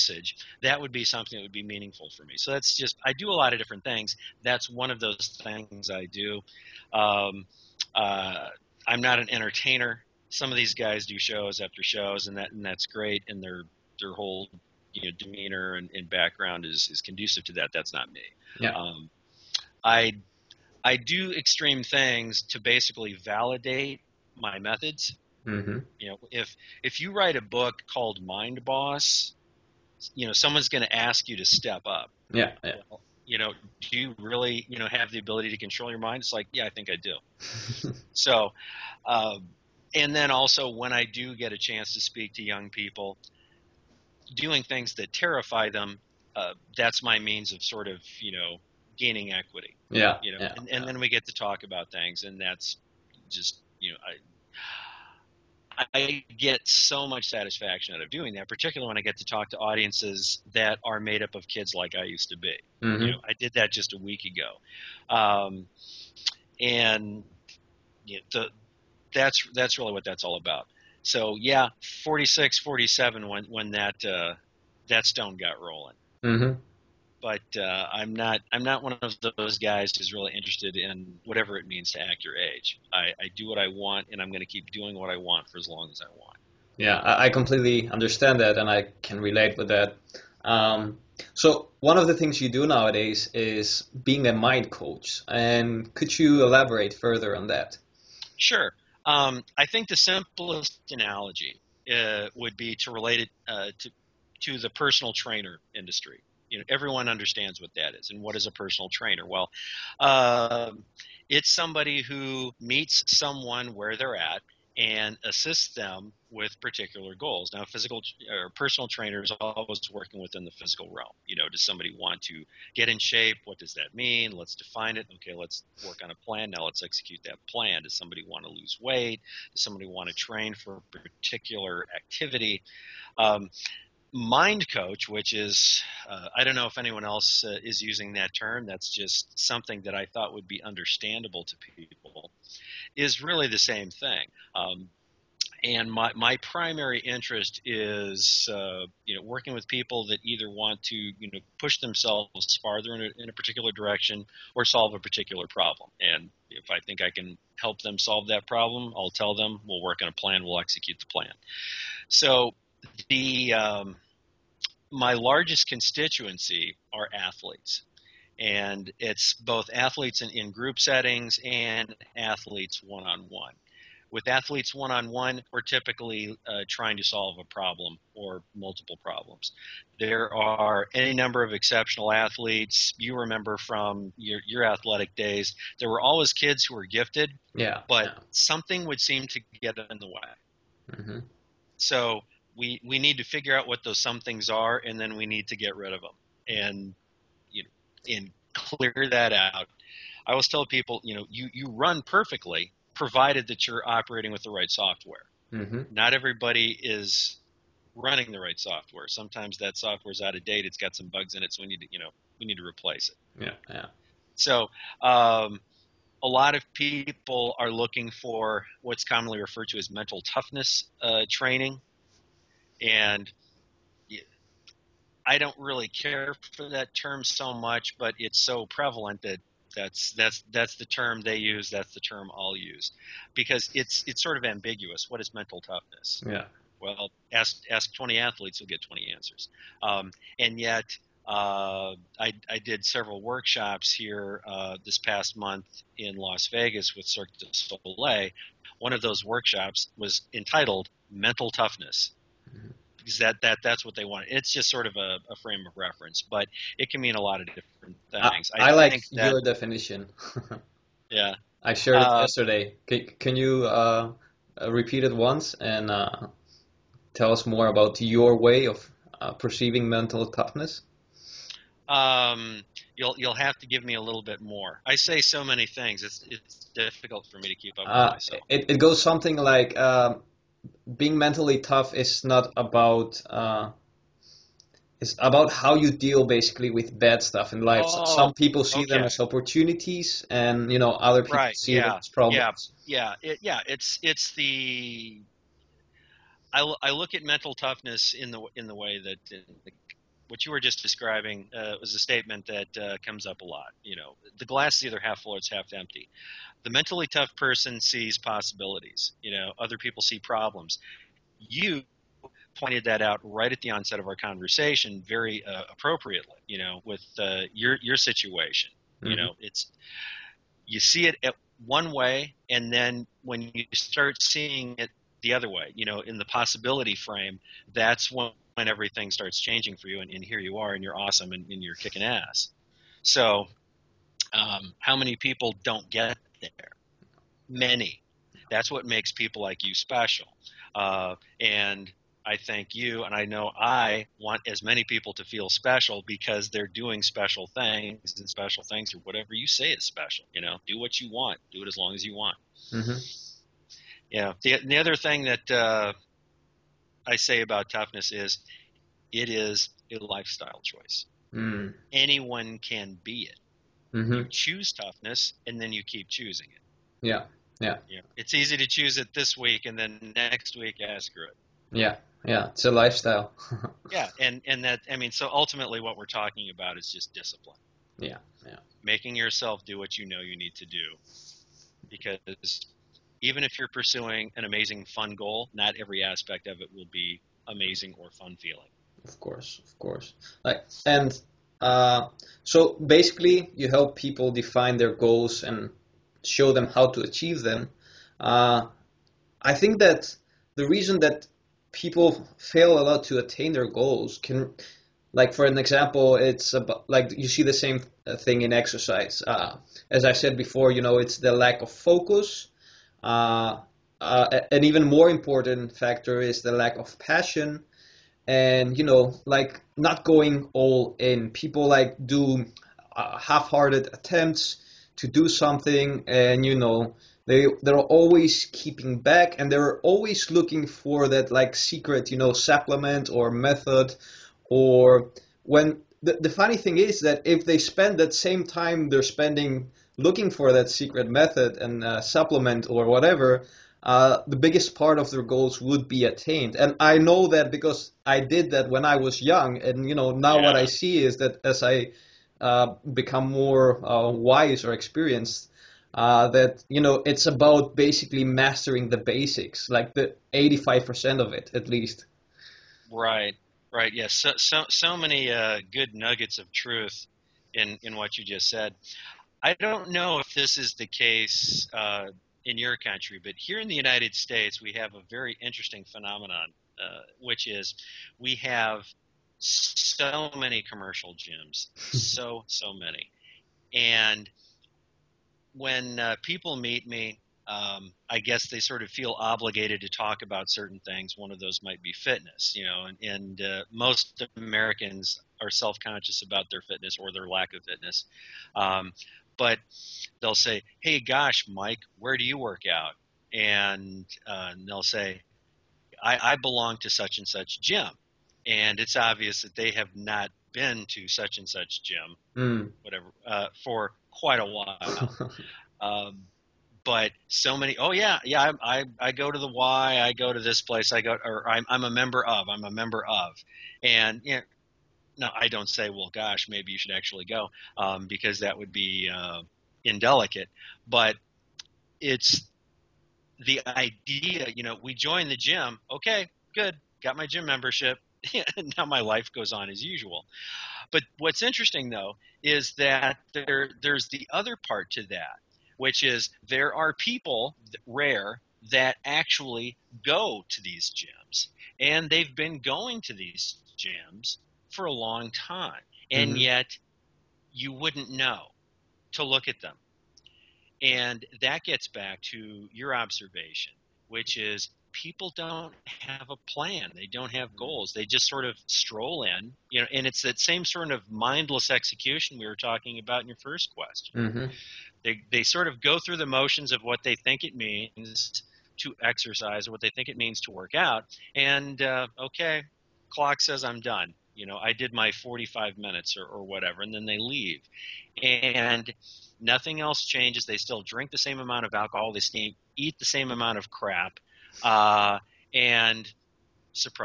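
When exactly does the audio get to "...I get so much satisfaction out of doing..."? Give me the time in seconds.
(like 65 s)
55 s.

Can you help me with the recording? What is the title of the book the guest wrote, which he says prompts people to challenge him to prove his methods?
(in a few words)
Mind Boss.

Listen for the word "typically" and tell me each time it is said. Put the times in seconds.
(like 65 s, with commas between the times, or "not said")
175 s.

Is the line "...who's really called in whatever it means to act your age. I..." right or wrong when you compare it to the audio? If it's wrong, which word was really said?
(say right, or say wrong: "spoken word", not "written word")
wrong: "interested", not "called".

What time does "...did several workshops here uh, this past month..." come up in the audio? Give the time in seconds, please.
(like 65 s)
242 s.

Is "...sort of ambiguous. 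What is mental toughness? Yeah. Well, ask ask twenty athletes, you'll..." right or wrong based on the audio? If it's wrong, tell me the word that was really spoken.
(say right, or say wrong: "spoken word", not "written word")
right.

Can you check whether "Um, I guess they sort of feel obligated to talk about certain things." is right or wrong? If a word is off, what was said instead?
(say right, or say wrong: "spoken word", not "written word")
right.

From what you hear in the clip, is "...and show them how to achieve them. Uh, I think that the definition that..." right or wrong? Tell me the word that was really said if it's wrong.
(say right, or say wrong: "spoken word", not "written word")
wrong: "reason", not "definition".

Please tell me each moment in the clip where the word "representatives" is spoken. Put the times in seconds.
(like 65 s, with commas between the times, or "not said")
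not said.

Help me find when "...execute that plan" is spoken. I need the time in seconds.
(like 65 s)
126 s.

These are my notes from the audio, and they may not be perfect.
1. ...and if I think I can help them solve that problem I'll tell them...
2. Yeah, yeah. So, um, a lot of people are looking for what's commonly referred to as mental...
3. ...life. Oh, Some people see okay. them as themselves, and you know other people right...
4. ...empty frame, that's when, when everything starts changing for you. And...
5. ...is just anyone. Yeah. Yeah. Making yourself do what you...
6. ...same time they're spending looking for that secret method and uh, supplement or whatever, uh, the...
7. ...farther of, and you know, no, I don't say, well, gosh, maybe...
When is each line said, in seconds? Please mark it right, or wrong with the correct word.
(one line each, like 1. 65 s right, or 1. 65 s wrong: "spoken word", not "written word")
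1. 155 s right
2. 213 s right
3. 287 s wrong: "opportunities", not "themselves"
4. 326 s wrong: "possibility", not "empty"
5. 376 s wrong: "discipline", not "anyone"
6. 438 s right
7. 522 s wrong: "member", not "farther".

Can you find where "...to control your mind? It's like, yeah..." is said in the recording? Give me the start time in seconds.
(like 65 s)
35 s.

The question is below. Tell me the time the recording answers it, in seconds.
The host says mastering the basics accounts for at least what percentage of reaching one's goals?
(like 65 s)
460 s.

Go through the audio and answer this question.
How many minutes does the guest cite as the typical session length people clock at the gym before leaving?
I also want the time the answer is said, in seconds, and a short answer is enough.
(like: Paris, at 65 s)
45, at 585 s.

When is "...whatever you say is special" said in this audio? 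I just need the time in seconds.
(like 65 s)
348 s.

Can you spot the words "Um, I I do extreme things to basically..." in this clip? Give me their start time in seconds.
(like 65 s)
18 s.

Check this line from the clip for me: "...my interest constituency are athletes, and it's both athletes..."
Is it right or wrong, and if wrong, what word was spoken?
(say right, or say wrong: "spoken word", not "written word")
wrong: "largest", not "interest".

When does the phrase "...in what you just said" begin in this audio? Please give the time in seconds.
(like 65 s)
467 s.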